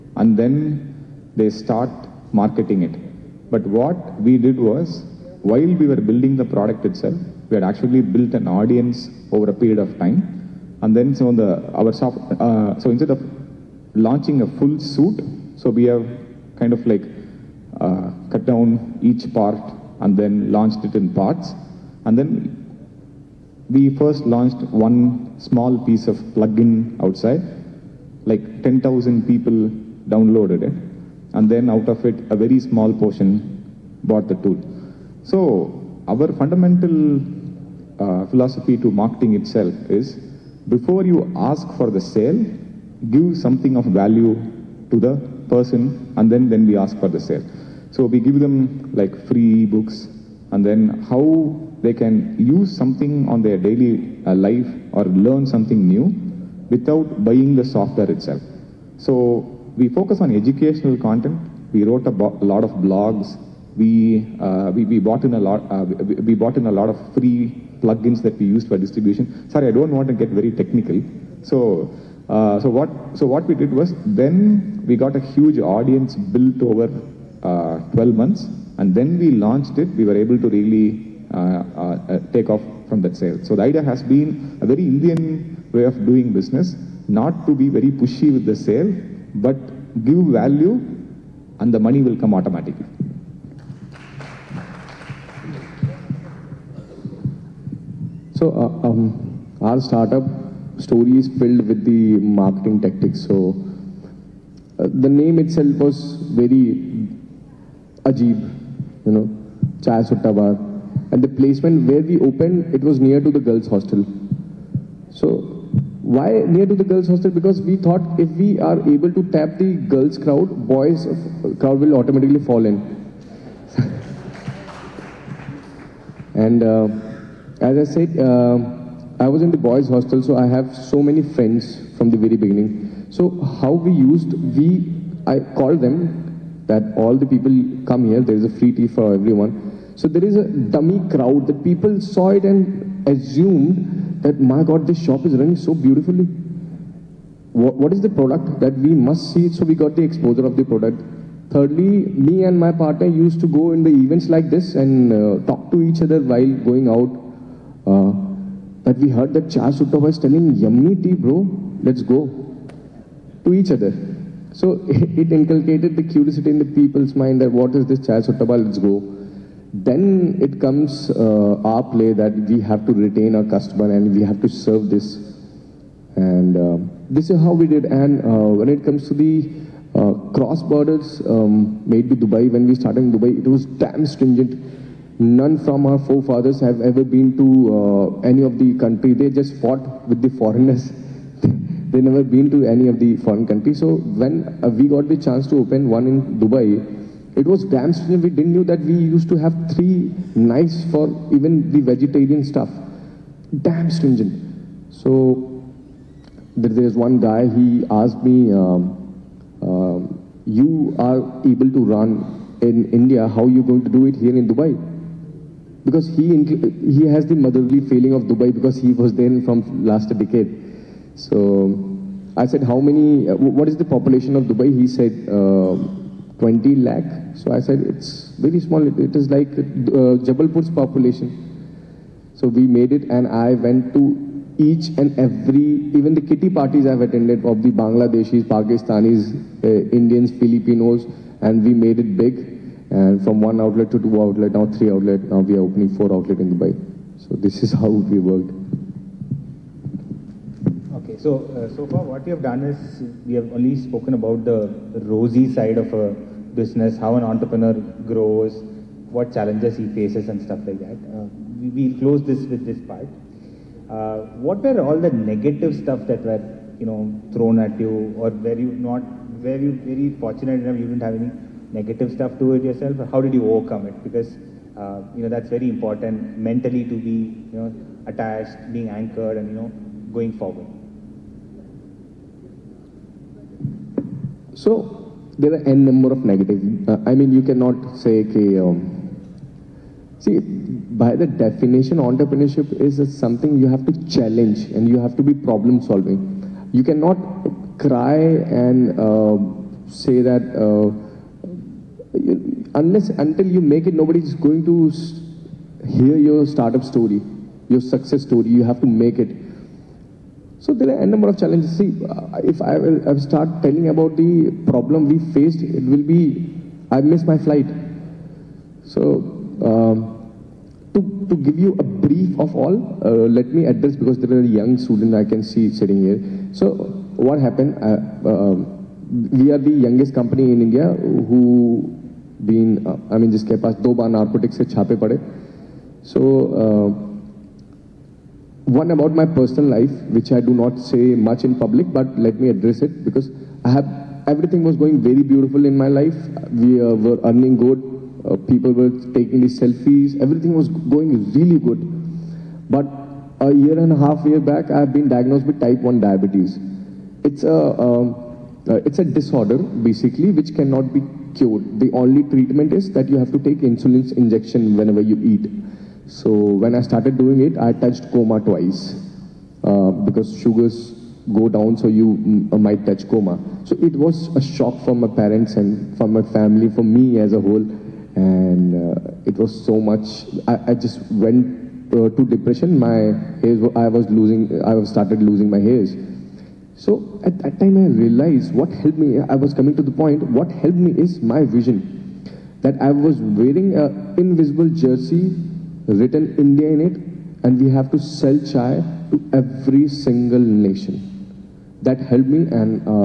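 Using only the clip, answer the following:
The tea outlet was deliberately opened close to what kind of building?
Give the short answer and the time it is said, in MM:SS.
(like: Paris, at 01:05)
girls' hostel, at 01:53.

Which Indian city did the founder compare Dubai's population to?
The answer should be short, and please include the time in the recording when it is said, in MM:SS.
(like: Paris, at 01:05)
Jabalpur, at 03:50.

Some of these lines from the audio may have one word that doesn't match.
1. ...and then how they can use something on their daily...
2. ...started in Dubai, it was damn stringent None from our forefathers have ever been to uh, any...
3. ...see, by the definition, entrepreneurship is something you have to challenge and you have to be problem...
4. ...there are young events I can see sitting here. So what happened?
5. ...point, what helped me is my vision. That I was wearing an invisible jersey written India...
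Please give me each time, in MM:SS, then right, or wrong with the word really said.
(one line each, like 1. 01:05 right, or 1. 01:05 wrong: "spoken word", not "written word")
1. 00:50 right
2. 03:02 right
3. 04:50 right
4. 05:24 wrong: "students", not "events"
5. 06:29 right.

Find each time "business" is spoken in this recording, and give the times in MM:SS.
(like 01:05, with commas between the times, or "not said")
01:26, 04:16.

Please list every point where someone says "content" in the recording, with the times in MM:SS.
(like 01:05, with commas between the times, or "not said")
01:00.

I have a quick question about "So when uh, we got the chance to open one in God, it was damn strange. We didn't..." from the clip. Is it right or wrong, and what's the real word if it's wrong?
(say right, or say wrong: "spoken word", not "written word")
wrong: "Dubai", not "God".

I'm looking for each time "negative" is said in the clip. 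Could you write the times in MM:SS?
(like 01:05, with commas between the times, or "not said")
04:25, 04:31, 04:46.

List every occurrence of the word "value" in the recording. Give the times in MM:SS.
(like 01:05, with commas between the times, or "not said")
00:43, 01:30.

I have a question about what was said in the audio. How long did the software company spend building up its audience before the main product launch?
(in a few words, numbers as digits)
12 months.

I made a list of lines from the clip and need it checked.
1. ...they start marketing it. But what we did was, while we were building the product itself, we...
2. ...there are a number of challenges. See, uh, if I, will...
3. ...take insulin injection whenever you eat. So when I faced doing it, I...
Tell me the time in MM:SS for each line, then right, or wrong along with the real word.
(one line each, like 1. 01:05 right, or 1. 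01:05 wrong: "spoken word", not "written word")
1. 00:01 right
2. 05:10 right
3. 06:03 wrong: "started", not "faced".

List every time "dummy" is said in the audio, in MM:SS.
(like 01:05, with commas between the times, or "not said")
02:20.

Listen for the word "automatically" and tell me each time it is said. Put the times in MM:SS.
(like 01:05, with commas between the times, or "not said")
01:32, 02:01.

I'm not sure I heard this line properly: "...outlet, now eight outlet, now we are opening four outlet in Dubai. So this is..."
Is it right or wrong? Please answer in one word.
wrong.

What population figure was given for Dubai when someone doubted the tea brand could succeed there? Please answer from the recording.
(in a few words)
20 lakh.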